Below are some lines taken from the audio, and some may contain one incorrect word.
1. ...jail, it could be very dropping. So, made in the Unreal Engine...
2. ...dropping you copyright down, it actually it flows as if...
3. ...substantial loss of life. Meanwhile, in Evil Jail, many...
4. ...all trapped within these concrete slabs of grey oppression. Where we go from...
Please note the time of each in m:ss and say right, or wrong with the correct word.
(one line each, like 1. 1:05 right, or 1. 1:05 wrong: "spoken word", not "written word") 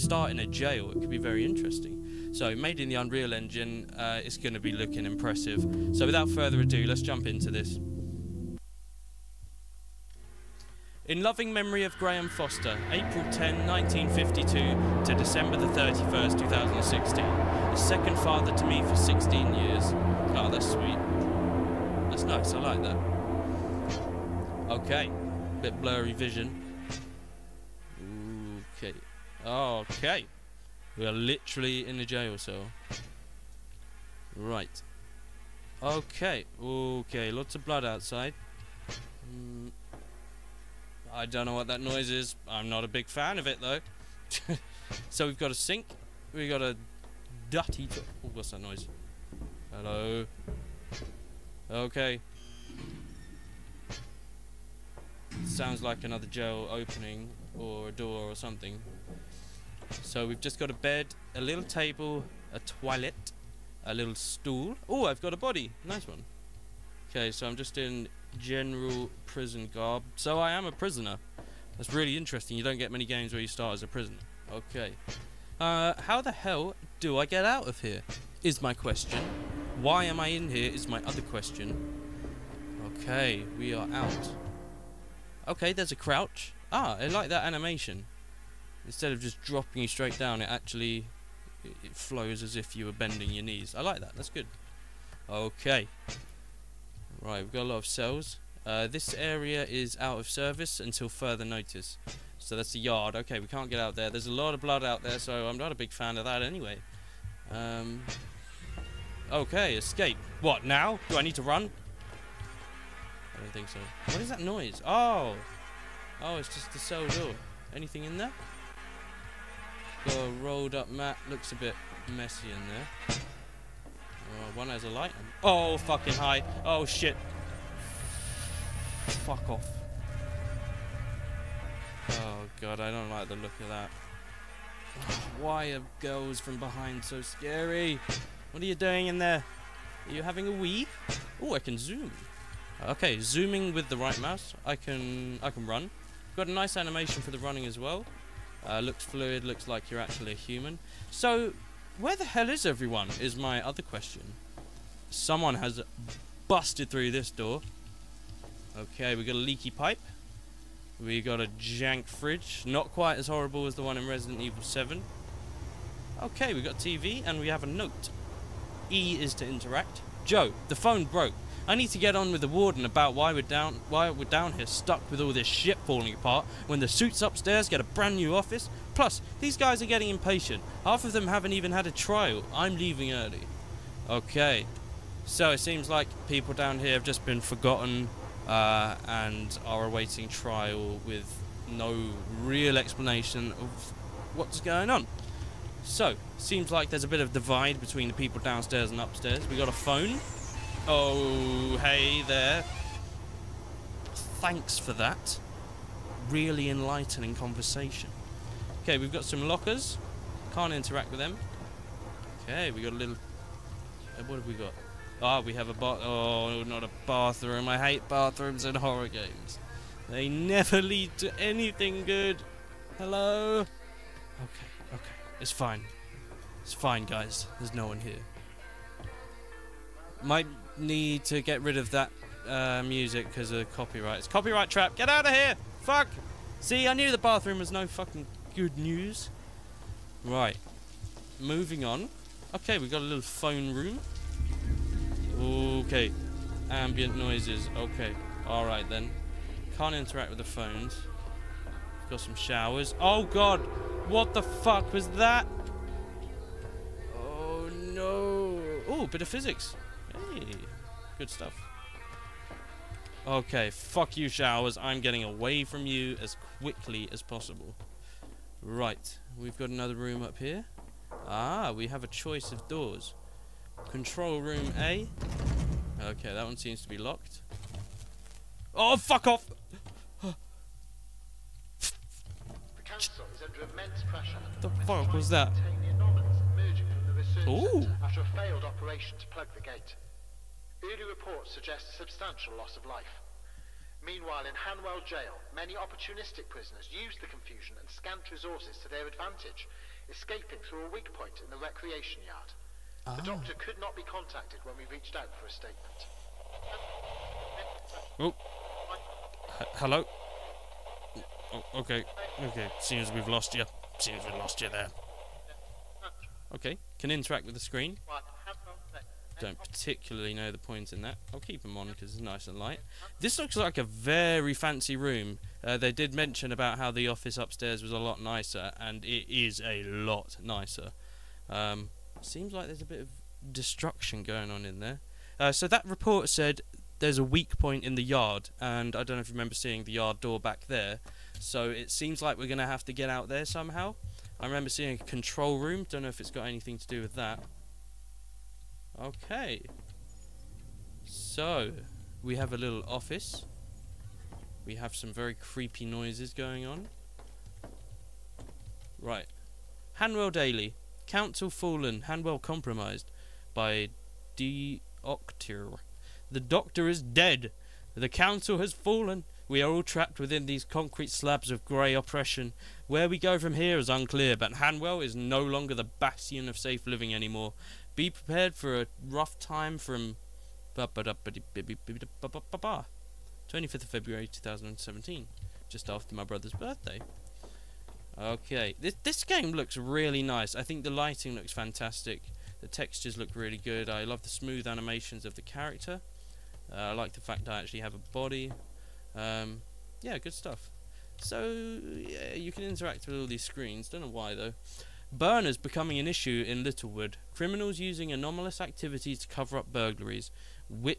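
1. 0:00 wrong: "interesting", not "dropping"
2. 1:29 wrong: "straight", not "copyright"
3. 4:51 wrong: "Hanwell", not "Evil"
4. 6:09 right.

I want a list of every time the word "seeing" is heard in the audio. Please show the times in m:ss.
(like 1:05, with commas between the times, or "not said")
5:39, 5:44.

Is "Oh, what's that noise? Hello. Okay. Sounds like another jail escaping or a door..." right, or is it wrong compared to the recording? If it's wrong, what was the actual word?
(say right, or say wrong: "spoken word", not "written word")
wrong: "opening", not "escaping".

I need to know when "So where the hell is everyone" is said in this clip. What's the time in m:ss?
2:31.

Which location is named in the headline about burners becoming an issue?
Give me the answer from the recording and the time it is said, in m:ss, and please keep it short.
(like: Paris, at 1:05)
Littlewood, at 6:46.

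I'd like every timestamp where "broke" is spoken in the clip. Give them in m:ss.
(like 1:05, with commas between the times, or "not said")
2:51.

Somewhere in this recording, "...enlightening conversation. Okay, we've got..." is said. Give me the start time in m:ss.
3:26.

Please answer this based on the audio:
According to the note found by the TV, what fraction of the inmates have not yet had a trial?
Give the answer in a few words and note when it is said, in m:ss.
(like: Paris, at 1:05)
Half, at 3:00.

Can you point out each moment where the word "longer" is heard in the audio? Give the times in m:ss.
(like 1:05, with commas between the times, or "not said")
6:15.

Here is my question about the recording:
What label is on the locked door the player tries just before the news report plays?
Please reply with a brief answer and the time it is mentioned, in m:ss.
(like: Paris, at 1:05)
Control room A, at 4:33.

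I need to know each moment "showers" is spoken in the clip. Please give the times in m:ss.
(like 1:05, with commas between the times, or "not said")
4:12, 4:24.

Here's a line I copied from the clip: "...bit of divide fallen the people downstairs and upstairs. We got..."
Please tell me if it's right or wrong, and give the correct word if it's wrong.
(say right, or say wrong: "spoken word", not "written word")
wrong: "between", not "fallen".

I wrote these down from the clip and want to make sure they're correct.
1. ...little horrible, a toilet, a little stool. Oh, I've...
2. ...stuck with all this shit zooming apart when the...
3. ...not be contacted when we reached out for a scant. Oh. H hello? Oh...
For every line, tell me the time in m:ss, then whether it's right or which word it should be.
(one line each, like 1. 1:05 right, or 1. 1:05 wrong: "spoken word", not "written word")
1. 1:01 wrong: "table", not "horrible"
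2. 2:54 wrong: "falling", not "zooming"
3. 5:03 wrong: "statement", not "scant".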